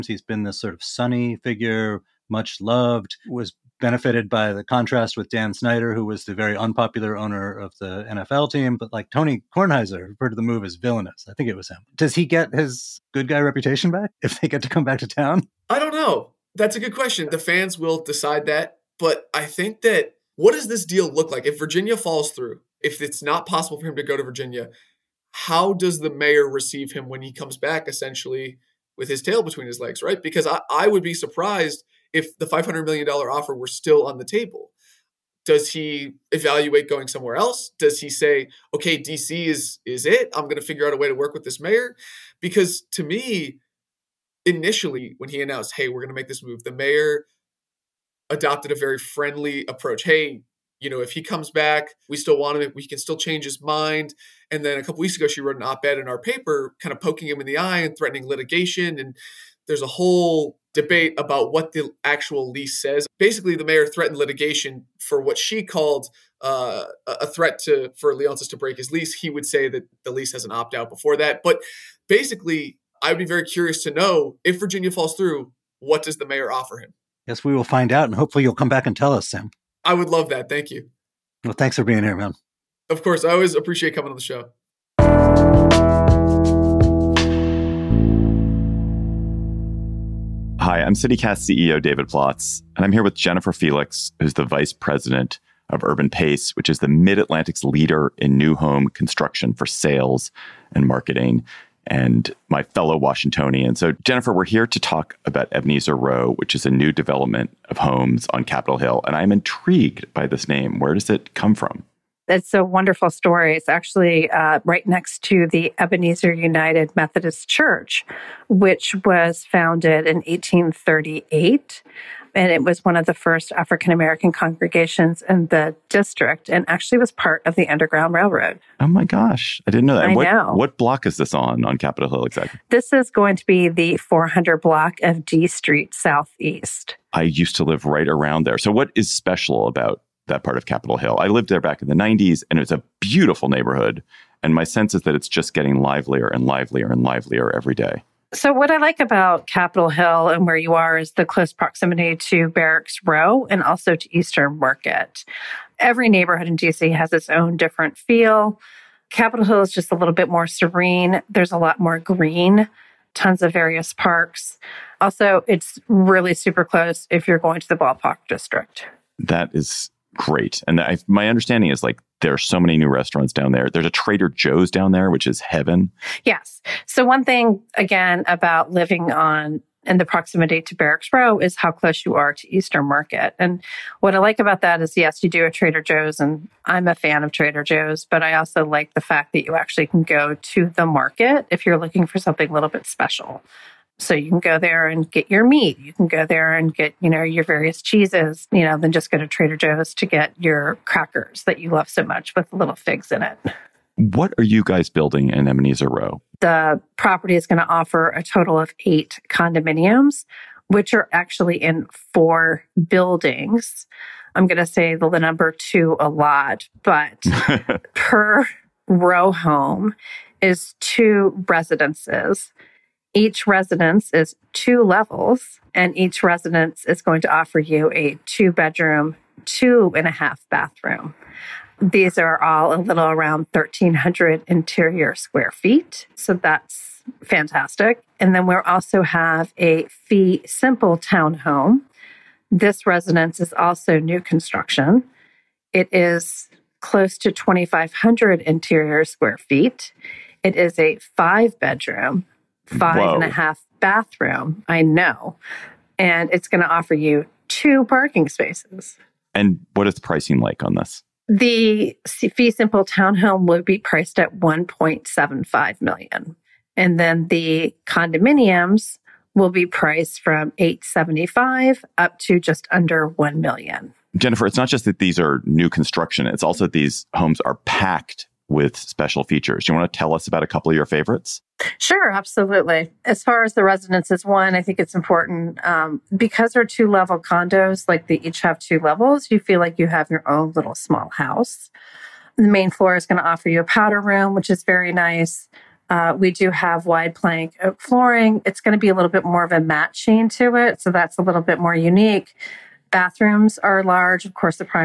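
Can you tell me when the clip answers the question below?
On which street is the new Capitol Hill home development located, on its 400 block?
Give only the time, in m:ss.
2:15.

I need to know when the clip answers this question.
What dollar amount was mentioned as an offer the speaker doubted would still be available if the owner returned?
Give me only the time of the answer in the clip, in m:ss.
0:32.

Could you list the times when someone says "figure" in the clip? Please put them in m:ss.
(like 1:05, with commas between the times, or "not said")
0:01, 0:40.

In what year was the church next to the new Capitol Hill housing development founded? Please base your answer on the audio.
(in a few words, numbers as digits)
1838.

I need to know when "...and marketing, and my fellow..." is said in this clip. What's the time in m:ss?
1:40.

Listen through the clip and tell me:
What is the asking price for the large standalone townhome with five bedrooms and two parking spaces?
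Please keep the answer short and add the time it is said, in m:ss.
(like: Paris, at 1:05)
$1.75 million, at 4:24.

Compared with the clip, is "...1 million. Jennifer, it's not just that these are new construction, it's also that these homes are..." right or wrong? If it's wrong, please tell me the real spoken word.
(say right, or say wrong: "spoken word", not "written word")
right.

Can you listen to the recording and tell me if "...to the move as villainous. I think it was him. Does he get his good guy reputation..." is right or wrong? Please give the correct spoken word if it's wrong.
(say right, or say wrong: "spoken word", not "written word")
right.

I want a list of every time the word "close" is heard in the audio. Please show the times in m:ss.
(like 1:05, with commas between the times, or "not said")
2:31, 2:46, 3:01, 4:06.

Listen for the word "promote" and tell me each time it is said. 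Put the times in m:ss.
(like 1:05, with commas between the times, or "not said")
not said.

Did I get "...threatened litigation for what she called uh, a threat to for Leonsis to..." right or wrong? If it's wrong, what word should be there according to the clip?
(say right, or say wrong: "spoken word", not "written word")
right.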